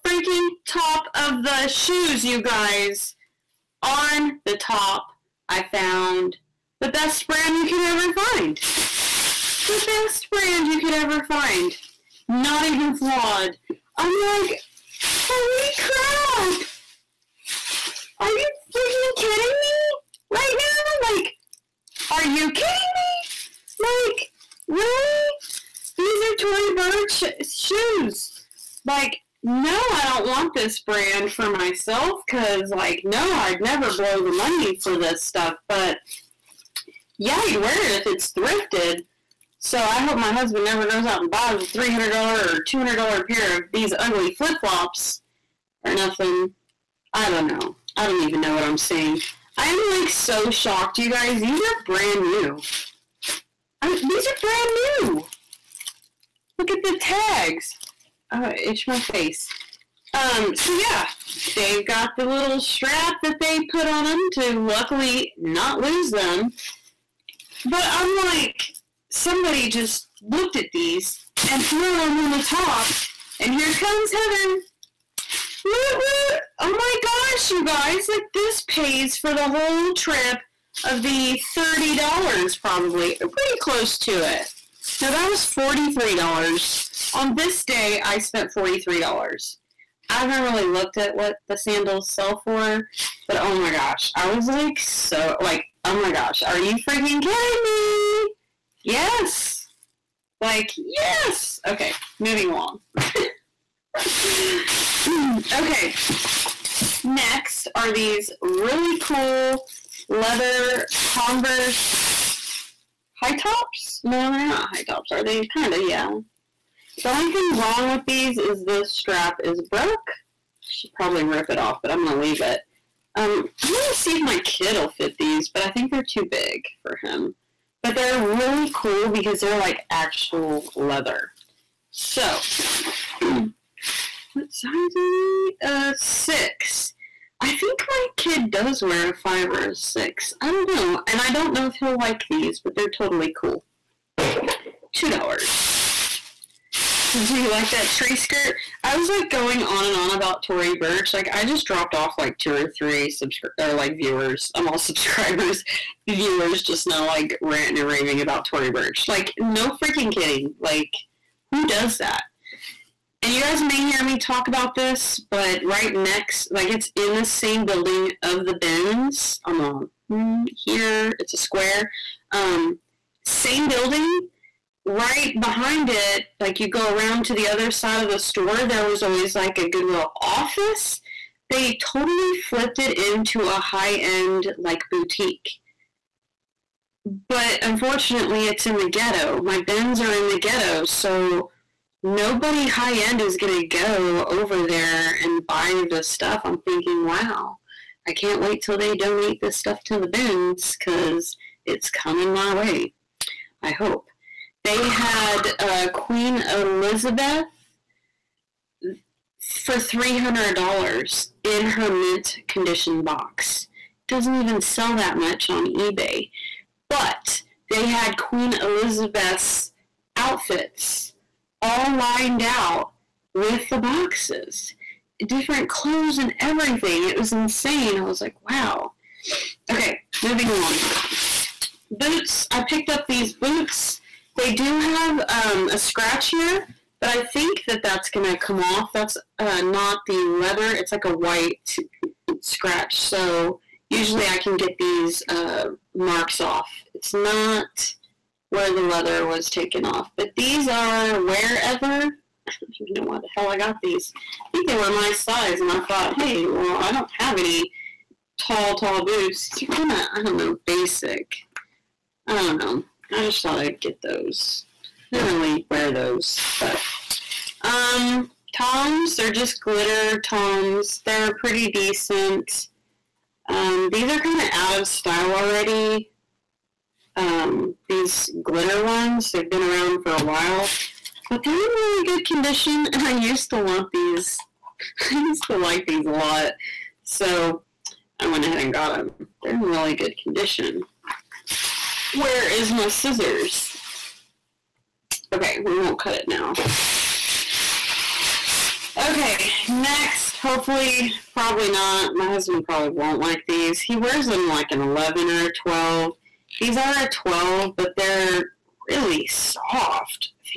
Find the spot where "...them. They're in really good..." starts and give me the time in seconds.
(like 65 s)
288 s.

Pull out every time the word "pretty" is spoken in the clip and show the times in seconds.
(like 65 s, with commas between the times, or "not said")
83 s, 271 s.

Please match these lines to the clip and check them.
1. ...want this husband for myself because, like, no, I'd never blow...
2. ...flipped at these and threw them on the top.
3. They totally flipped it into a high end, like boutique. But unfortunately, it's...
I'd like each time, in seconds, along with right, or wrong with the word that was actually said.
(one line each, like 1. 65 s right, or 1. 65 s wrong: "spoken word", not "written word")
1. 30 s wrong: "brand", not "husband"
2. 70 s wrong: "looked", not "flipped"
3. 181 s right.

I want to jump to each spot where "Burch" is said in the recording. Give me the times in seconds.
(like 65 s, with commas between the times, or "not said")
26 s, 150 s, 158 s.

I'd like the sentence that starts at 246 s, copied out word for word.
It's not where the leather was taken off, but these are wherever.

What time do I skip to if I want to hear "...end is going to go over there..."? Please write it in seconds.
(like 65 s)
192 s.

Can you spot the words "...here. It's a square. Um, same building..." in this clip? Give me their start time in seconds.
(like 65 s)
170 s.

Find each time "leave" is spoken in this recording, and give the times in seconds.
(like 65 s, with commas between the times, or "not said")
122 s.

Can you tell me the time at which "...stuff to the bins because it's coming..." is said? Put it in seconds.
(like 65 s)
199 s.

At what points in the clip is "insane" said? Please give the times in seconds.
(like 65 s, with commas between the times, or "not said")
227 s.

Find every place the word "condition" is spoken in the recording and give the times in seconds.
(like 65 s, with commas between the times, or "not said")
212 s, 282 s, 290 s.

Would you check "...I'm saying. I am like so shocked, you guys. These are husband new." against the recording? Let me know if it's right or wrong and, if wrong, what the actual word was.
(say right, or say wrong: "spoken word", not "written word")
wrong: "brand", not "husband".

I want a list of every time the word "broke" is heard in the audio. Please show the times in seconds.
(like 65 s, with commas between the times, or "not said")
119 s.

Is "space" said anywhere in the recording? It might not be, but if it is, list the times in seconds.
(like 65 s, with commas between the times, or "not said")
not said.